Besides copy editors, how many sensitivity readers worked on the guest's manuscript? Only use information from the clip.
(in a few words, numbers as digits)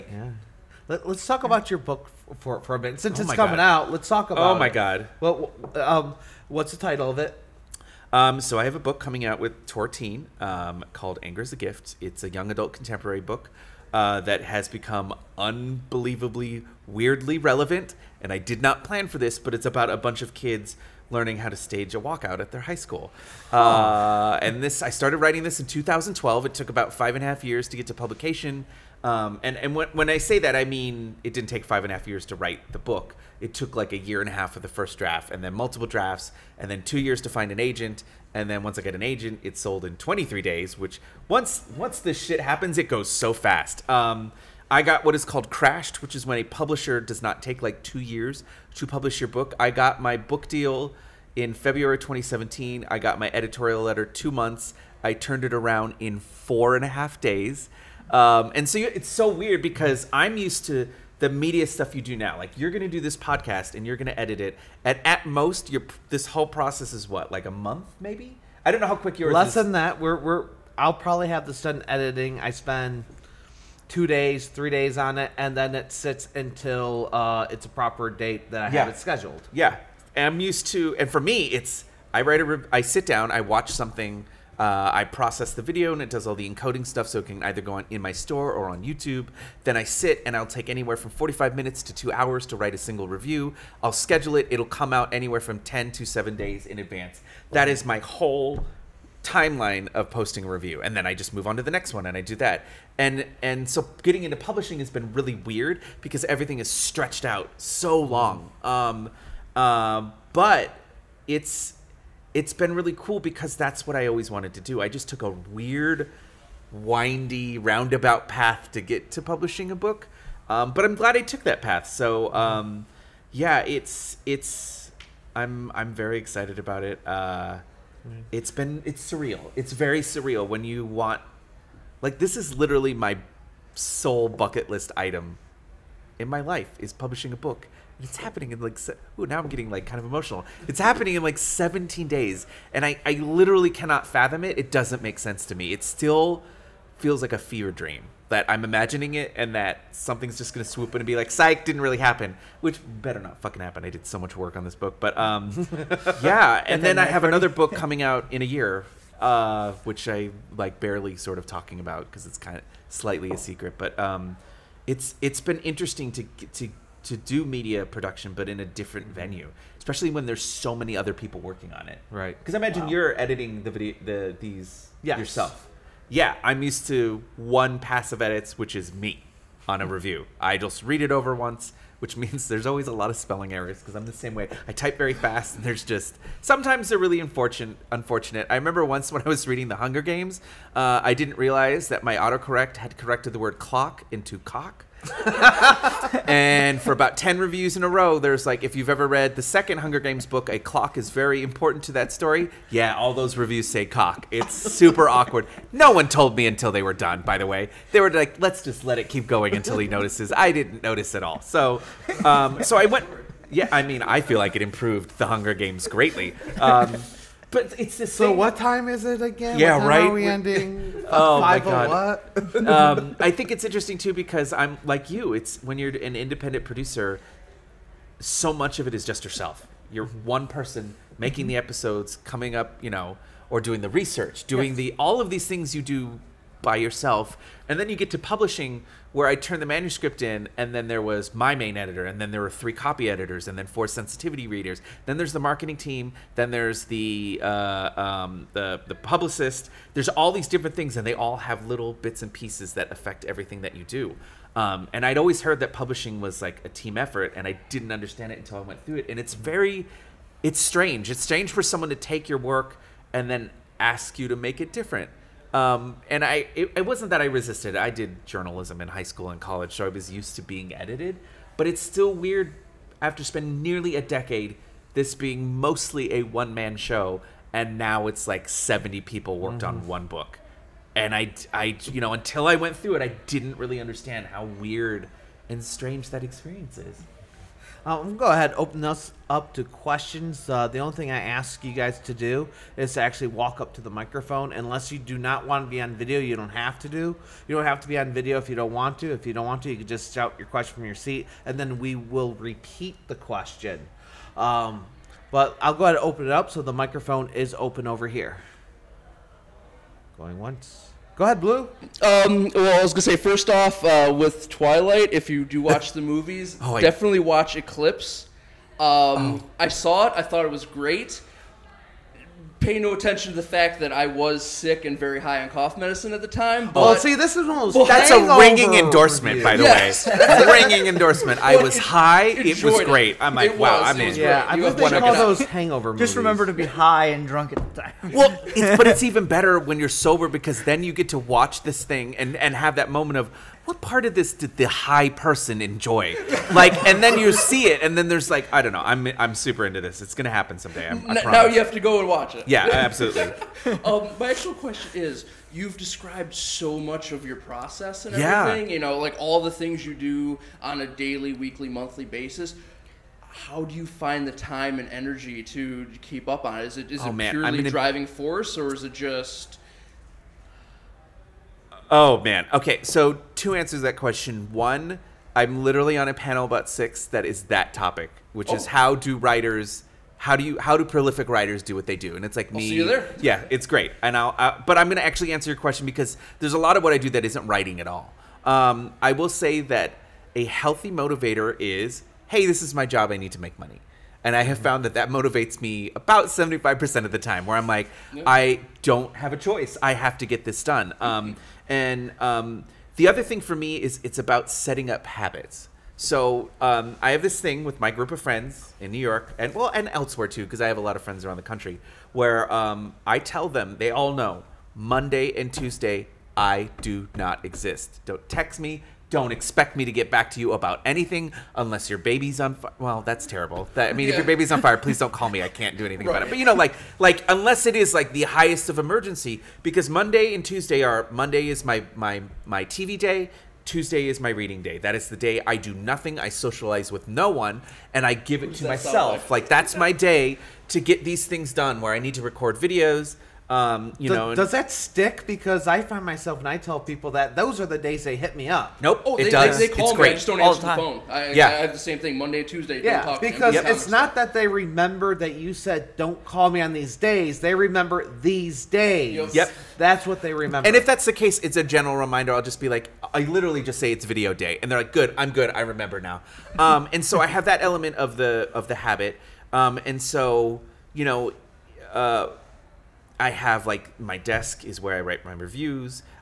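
4.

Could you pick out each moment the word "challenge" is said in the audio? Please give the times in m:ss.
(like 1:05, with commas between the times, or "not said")
not said.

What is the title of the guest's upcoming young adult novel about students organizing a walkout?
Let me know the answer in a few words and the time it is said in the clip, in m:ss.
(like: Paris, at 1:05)
Anger Is a Gift, at 0:11.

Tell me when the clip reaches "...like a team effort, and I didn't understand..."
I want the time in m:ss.
4:16.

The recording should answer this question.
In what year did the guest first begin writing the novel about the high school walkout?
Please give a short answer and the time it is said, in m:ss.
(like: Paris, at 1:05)
2012, at 0:25.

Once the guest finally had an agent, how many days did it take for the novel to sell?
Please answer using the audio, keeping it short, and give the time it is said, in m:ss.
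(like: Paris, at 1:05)
23, at 0:39.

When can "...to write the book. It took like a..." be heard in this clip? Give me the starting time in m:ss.
0:32.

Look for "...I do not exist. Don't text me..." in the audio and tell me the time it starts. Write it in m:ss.
6:56.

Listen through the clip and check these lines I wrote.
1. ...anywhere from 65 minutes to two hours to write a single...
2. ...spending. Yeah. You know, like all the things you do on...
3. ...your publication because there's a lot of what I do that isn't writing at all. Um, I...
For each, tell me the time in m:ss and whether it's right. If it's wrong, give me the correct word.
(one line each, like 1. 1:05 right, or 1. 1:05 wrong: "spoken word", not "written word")
1. 1:30 wrong: "45", not "65"
2. 5:58 wrong: "everything", not "spending"
3. 6:25 wrong: "question", not "publication".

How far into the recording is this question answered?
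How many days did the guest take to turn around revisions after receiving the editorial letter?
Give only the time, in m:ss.
0:56.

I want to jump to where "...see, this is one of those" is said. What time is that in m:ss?
5:26.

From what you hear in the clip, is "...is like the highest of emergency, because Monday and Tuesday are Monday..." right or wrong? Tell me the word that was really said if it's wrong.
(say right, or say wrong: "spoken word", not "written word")
right.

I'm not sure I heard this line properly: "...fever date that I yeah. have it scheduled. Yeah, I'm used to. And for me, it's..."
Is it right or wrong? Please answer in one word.
wrong.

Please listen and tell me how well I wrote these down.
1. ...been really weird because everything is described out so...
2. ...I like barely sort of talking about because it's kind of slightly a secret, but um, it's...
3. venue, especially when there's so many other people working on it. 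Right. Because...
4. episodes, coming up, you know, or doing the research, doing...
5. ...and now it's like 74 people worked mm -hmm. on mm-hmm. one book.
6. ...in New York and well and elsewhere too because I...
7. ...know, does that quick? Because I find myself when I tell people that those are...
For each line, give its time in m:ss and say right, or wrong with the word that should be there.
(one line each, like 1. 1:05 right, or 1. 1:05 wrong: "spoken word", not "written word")
1. 1:44 wrong: "stretched", not "described"
2. 2:40 right
3. 2:49 right
4. 3:51 right
5. 4:37 wrong: "70", not "74"
6. 6:48 right
7. 7:24 wrong: "stick", not "quick".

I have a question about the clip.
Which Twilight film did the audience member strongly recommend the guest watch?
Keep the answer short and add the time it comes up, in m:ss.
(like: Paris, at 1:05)
Eclipse, at 5:17.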